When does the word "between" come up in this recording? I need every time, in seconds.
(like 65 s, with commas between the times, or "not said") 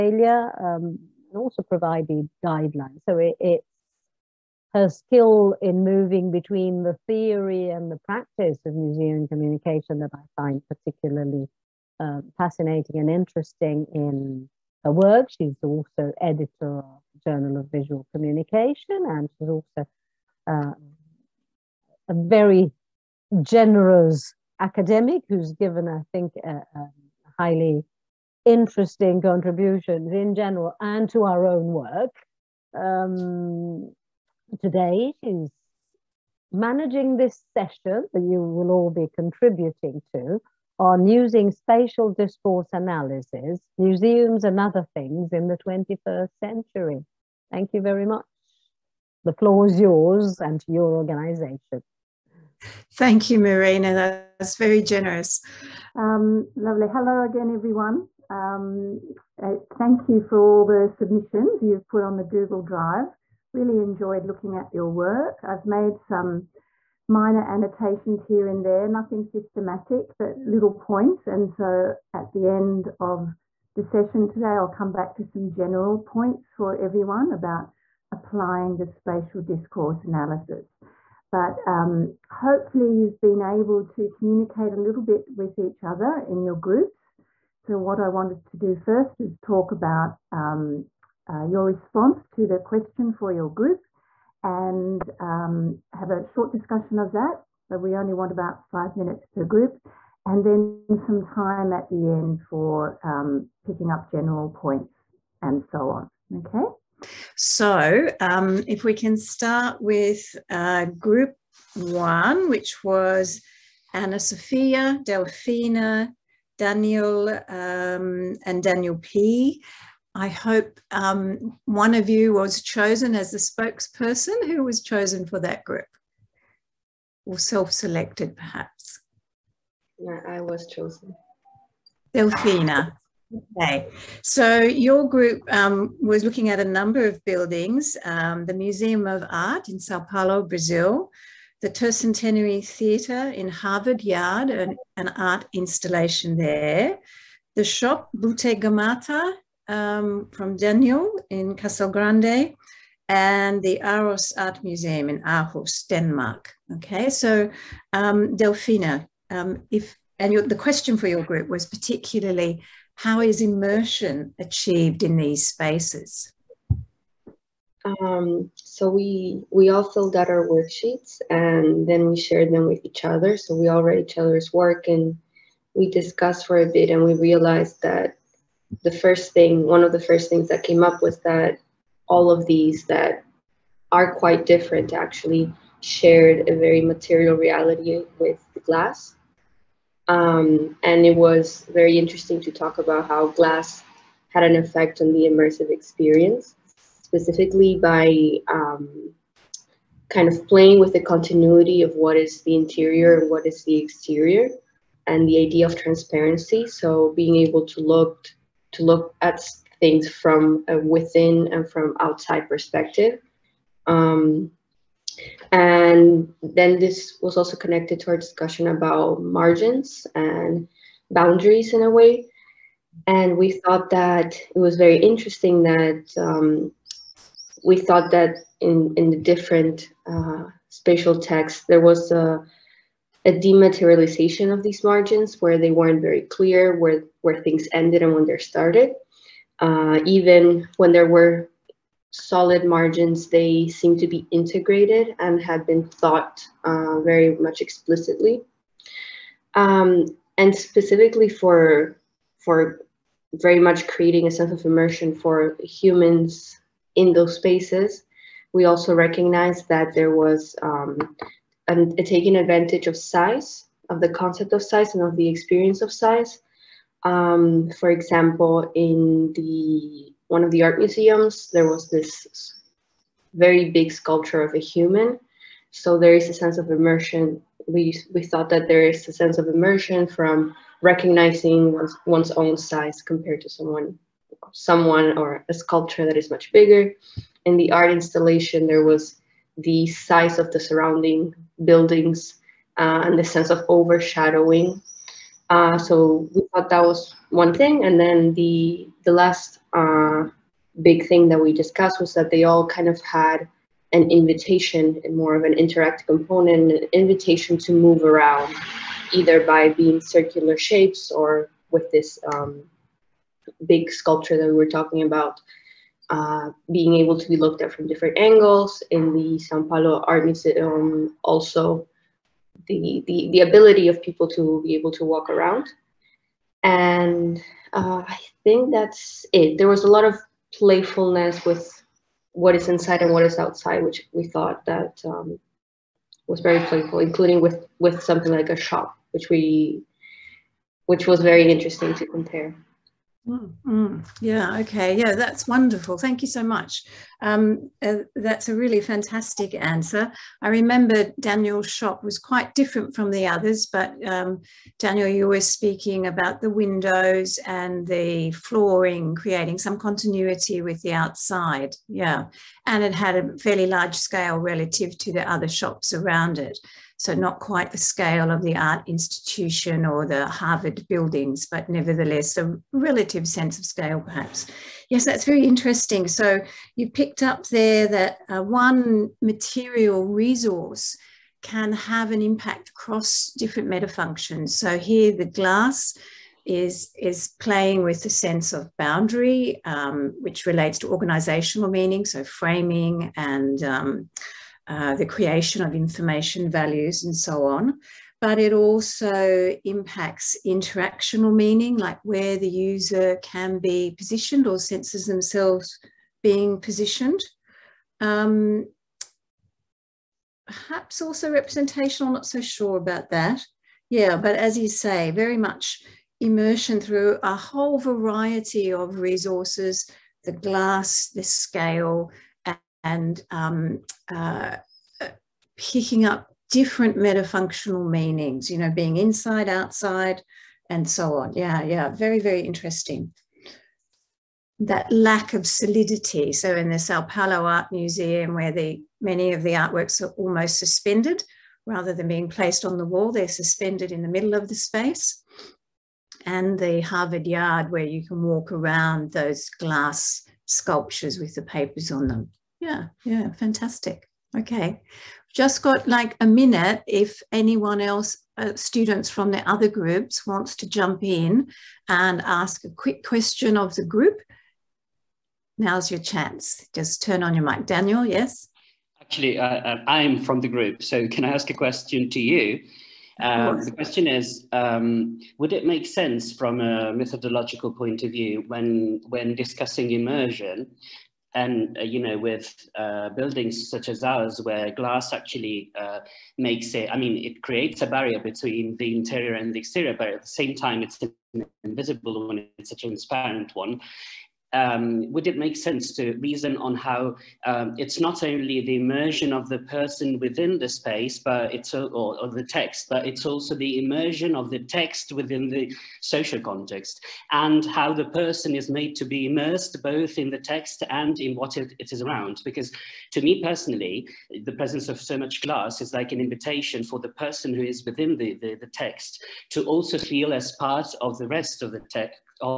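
6 s, 488 s.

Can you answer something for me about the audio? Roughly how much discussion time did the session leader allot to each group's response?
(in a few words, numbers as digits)
5 minutes.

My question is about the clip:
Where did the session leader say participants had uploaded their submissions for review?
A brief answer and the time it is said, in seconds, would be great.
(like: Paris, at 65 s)
Google Drive, at 62 s.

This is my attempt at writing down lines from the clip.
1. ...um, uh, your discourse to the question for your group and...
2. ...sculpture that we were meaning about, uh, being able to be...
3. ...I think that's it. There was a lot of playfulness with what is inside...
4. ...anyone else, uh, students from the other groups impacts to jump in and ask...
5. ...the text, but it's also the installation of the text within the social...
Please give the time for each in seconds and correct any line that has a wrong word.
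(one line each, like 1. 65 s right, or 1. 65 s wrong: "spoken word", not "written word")
1. 90 s wrong: "response", not "discourse"
2. 313 s wrong: "talking", not "meaning"
3. 328 s right
4. 457 s wrong: "wants", not "impacts"
5. 502 s wrong: "immersion", not "installation".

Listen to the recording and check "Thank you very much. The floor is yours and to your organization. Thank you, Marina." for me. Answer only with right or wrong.
right.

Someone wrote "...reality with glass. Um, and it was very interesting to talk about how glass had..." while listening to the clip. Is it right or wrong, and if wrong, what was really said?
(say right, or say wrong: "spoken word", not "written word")
right.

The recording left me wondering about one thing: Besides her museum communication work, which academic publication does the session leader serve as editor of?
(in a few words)
Journal of Visual Communication.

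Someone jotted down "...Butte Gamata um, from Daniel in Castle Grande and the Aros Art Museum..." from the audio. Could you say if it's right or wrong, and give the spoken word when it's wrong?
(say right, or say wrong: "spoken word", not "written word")
right.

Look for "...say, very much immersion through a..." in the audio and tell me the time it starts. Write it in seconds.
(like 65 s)
414 s.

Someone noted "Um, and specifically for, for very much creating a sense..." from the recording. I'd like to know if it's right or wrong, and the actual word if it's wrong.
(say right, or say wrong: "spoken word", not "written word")
right.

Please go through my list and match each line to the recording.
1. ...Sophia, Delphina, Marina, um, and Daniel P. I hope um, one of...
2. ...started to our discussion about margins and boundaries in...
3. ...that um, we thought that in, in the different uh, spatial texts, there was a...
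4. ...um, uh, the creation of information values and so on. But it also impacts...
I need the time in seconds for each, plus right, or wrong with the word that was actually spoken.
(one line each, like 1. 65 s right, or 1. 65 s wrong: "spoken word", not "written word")
1. 114 s wrong: "Daniel", not "Marina"
2. 217 s wrong: "connected", not "started"
3. 225 s right
4. 393 s right.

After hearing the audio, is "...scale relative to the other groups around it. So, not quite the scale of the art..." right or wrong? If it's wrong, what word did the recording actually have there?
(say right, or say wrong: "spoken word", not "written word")
wrong: "shops", not "groups".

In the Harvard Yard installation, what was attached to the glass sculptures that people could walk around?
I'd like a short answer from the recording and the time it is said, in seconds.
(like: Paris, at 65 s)
Papers, at 451 s.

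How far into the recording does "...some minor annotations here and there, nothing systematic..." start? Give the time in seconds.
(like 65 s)
65 s.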